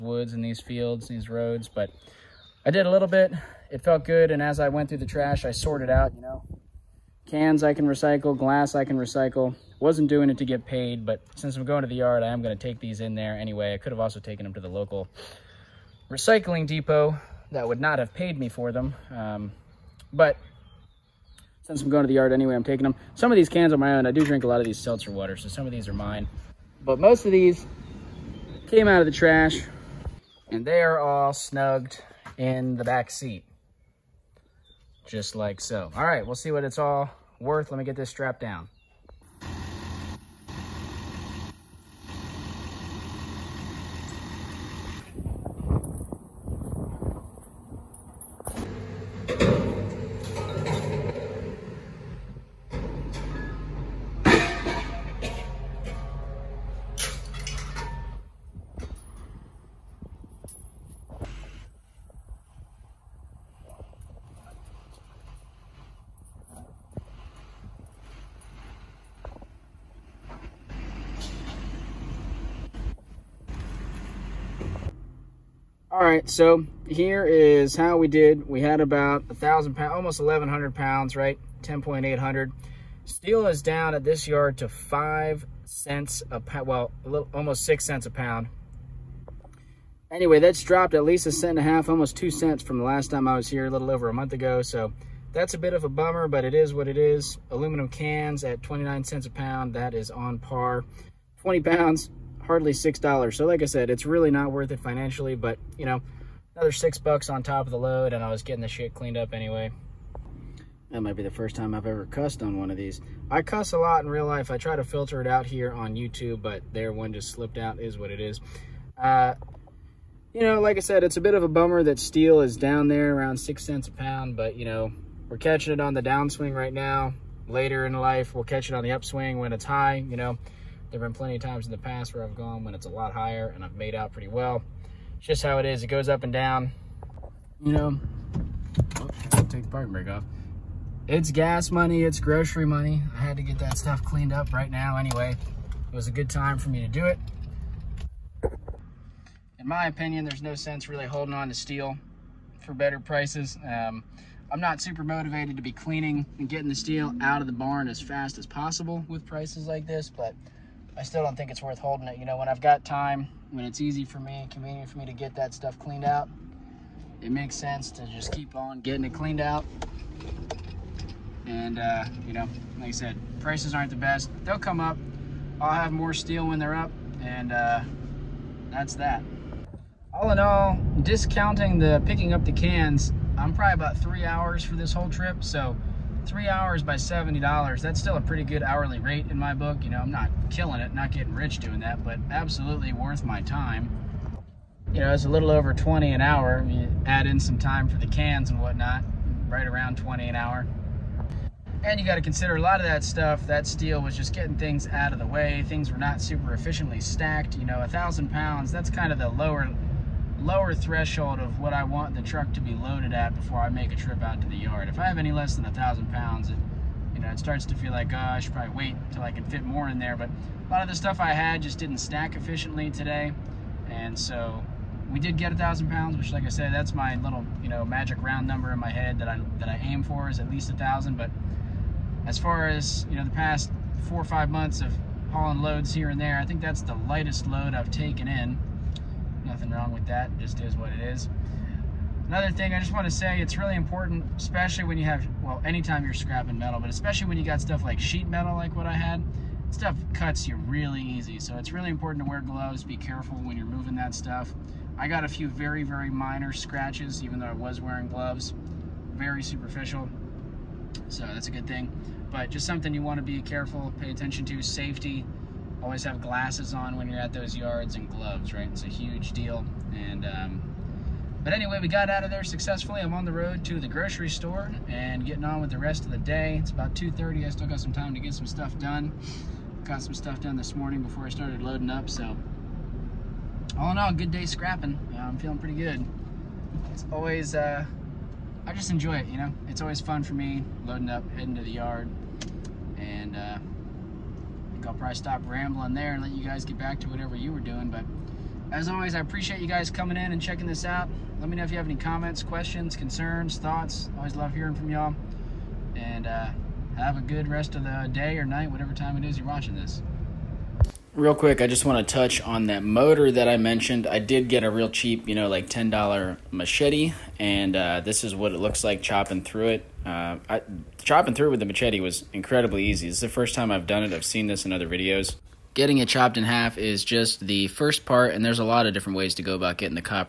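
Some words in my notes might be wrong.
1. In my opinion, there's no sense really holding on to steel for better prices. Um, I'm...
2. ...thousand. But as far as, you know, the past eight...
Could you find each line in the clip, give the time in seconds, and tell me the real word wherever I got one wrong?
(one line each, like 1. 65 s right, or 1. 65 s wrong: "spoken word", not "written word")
1. 149 s right
2. 230 s wrong: "four", not "eight".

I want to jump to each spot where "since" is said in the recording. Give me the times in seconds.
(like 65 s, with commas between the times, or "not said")
11 s, 21 s.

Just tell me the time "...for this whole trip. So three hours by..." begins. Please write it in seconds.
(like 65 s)
184 s.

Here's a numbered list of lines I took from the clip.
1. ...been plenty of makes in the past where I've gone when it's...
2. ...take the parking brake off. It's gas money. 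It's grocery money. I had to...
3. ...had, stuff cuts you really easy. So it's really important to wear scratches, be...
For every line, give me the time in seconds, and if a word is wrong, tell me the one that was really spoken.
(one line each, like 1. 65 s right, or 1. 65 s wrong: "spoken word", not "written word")
1. 131 s wrong: "times", not "makes"
2. 139 s right
3. 248 s wrong: "gloves", not "scratches".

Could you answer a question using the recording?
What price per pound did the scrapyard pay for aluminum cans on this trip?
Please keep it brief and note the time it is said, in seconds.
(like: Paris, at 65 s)
29 cents, at 98 s.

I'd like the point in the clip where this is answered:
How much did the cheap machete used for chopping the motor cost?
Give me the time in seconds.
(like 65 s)
315 s.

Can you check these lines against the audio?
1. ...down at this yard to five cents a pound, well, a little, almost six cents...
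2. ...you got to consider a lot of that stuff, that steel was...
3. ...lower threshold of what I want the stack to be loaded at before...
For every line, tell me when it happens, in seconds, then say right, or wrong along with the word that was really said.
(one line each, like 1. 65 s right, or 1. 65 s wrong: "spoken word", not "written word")
1. 83 s right
2. 201 s right
3. 210 s wrong: "truck", not "stack".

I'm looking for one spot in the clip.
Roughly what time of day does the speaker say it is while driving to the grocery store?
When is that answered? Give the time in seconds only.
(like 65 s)
276 s.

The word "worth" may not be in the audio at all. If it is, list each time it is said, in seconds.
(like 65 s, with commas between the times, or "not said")
37 s, 104 s, 161 s, 192 s.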